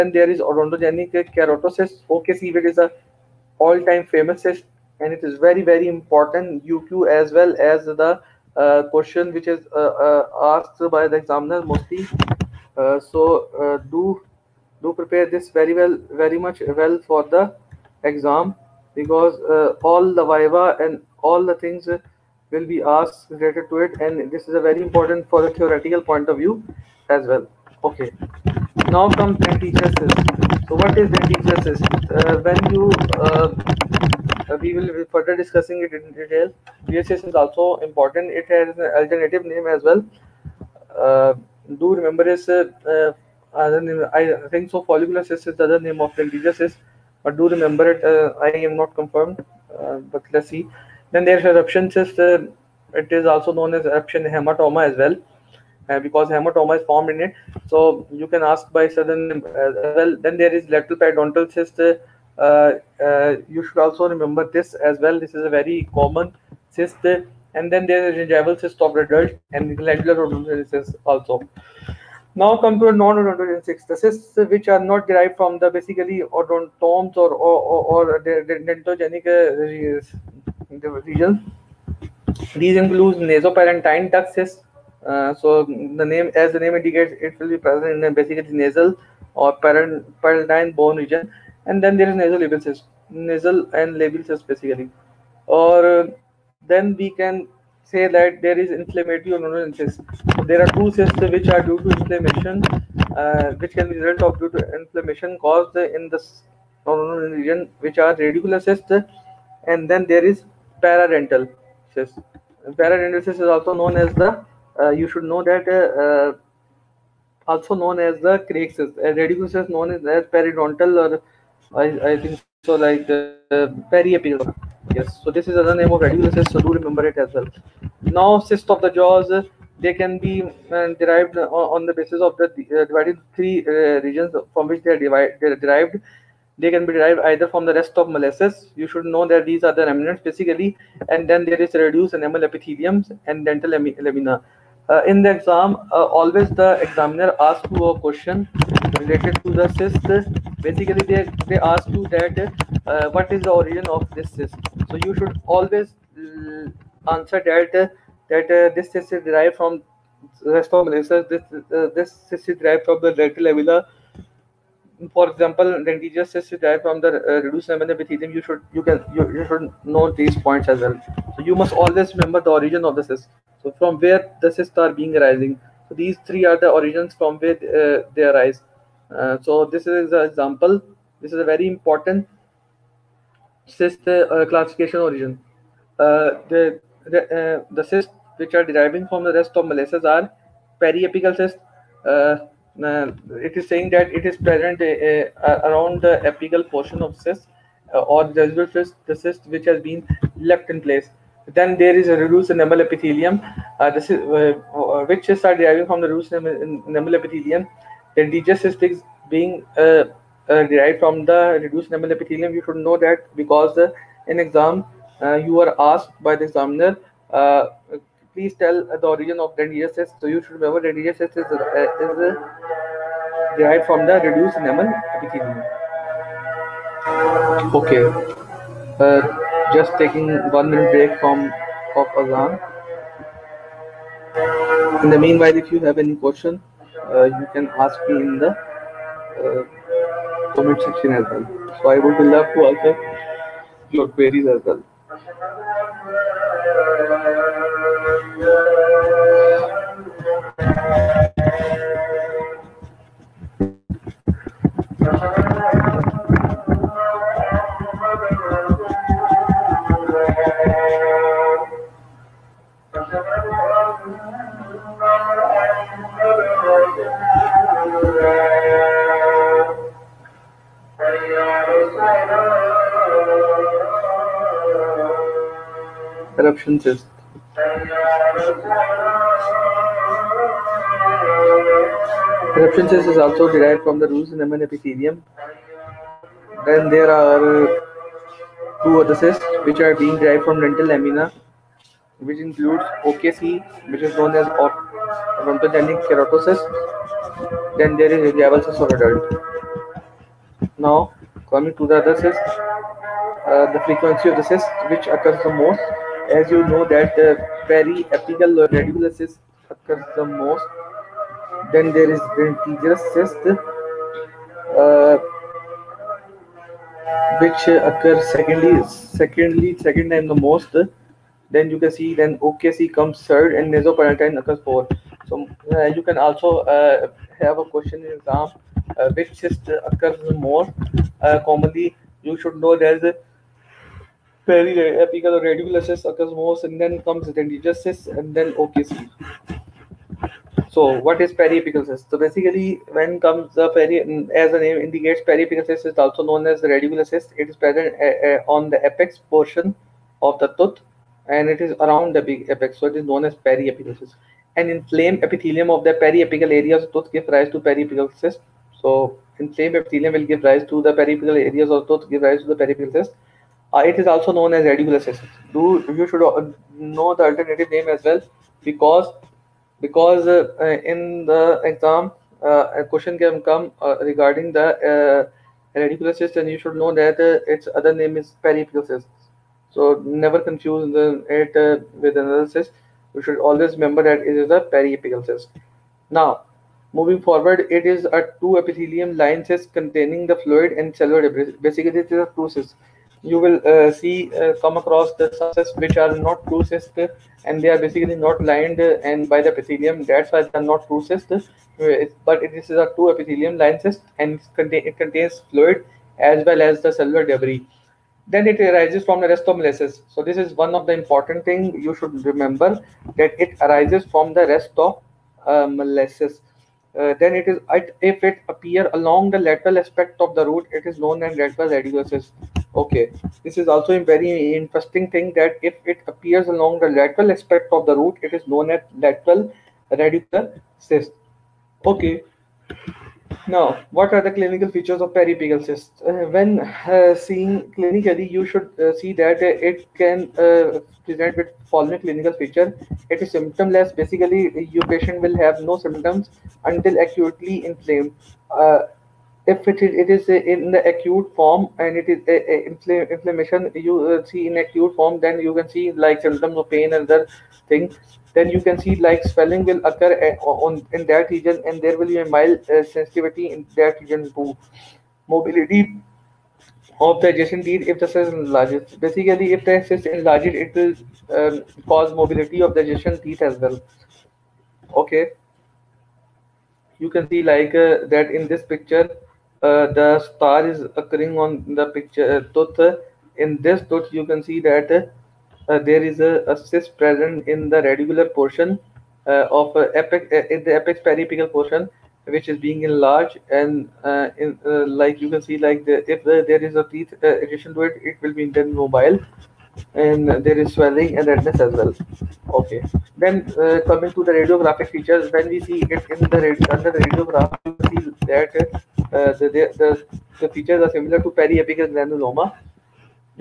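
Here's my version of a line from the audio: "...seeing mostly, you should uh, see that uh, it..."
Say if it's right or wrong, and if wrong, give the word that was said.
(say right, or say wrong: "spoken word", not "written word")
wrong: "clinically", not "mostly".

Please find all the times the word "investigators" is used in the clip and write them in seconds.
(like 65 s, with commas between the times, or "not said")
not said.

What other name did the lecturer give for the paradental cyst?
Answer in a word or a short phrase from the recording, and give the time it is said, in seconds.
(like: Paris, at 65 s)
Craig cyst, at 118 s.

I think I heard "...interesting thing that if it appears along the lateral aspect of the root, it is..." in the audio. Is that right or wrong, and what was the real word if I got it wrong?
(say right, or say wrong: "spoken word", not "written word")
right.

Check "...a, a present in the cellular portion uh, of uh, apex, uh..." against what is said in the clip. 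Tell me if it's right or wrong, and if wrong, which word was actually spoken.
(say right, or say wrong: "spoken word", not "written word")
wrong: "radicular", not "cellular".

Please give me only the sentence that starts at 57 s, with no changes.
So you can ask by sudden well.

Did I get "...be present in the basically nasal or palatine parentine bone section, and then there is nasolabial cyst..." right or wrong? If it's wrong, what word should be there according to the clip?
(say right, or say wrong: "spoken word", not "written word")
wrong: "region", not "section".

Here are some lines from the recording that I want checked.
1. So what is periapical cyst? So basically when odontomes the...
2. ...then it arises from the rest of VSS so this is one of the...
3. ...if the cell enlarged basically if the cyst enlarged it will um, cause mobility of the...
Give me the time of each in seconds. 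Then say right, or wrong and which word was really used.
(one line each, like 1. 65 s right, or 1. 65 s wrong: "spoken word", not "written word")
1. 340 s wrong: "comes", not "odontomes"
2. 408 s wrong: "Malassez", not "VSS"
3. 467 s right.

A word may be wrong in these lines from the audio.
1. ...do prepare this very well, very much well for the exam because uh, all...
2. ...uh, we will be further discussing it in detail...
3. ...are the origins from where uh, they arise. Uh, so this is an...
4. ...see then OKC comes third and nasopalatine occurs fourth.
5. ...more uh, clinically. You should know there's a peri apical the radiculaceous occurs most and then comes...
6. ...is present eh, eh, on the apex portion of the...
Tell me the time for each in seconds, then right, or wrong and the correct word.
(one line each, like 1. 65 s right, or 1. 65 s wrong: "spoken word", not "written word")
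1. 14 s right
2. 33 s right
3. 176 s right
4. 321 s right
5. 330 s wrong: "commonly", not "clinically"
6. 347 s right.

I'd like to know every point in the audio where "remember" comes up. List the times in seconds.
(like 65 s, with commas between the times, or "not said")
41 s, 47 s, 64 s, 126 s, 172 s, 220 s, 383 s, 412 s.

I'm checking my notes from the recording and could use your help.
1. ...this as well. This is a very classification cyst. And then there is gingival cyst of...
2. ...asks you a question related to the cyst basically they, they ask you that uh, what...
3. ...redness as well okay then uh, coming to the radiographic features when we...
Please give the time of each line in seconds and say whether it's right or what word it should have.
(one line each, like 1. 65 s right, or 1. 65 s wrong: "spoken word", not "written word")
1. 64 s wrong: "common", not "classification"
2. 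147 s right
3. 501 s right.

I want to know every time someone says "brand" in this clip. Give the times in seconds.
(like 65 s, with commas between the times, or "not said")
not said.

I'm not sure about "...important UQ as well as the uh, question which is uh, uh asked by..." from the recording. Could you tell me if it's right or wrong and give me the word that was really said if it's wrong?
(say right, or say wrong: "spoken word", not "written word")
right.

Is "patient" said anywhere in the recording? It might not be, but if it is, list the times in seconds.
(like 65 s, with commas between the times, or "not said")
444 s.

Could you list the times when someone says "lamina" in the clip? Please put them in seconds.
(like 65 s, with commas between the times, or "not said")
143 s, 290 s.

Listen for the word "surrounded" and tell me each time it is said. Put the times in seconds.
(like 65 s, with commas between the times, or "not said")
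not said.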